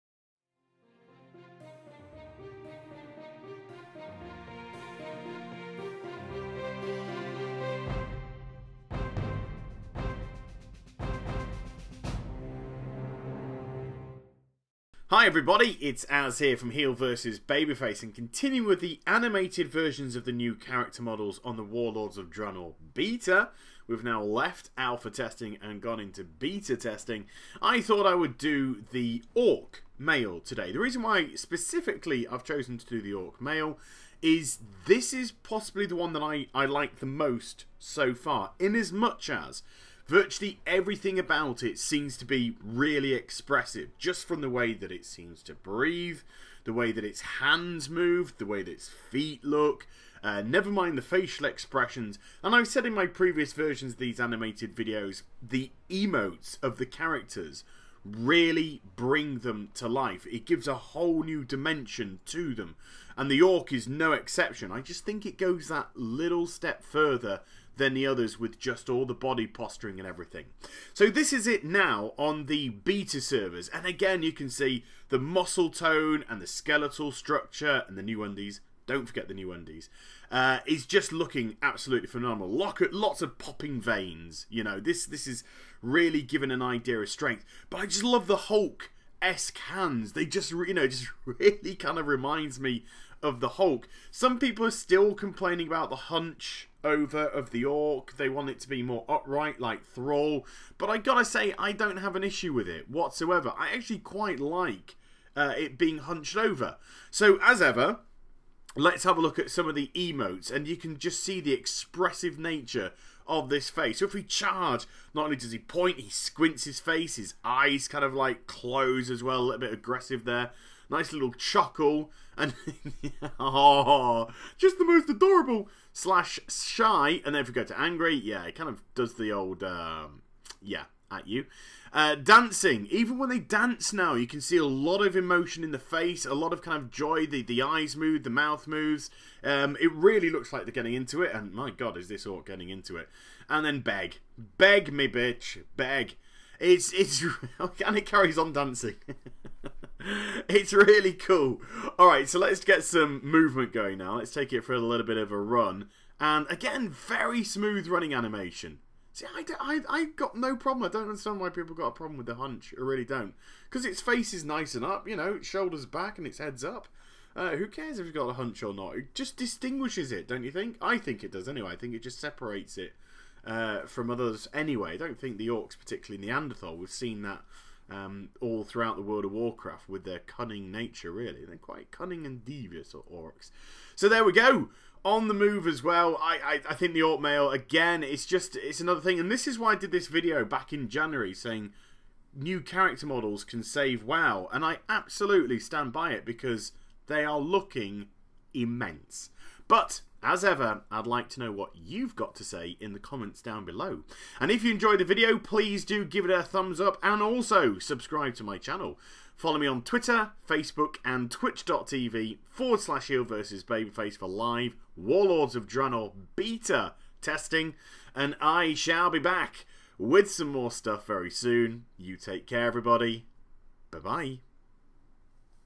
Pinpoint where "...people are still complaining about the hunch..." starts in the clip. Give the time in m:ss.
1:34.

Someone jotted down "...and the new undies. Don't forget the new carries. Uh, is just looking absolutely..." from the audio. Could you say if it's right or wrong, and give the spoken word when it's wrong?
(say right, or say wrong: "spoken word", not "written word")
wrong: "undies", not "carries".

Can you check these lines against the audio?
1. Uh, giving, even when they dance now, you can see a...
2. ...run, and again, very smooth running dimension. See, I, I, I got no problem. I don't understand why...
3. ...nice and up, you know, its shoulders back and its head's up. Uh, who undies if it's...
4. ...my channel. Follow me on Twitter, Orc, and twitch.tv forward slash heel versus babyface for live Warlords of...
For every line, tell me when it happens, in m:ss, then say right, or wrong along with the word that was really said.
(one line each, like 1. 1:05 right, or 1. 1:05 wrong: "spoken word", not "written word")
1. 2:11 wrong: "dancing", not "giving"
2. 2:35 wrong: "animation", not "dimension"
3. 2:44 wrong: "cares", not "undies"
4. 3:28 wrong: "Facebook", not "Orc".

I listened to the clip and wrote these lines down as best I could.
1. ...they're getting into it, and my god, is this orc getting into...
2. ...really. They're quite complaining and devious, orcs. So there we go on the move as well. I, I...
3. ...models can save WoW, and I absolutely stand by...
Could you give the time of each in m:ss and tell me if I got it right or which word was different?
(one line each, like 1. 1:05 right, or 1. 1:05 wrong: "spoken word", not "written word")
1. 2:20 right
2. 3:01 wrong: "cunning", not "complaining"
3. 3:13 right.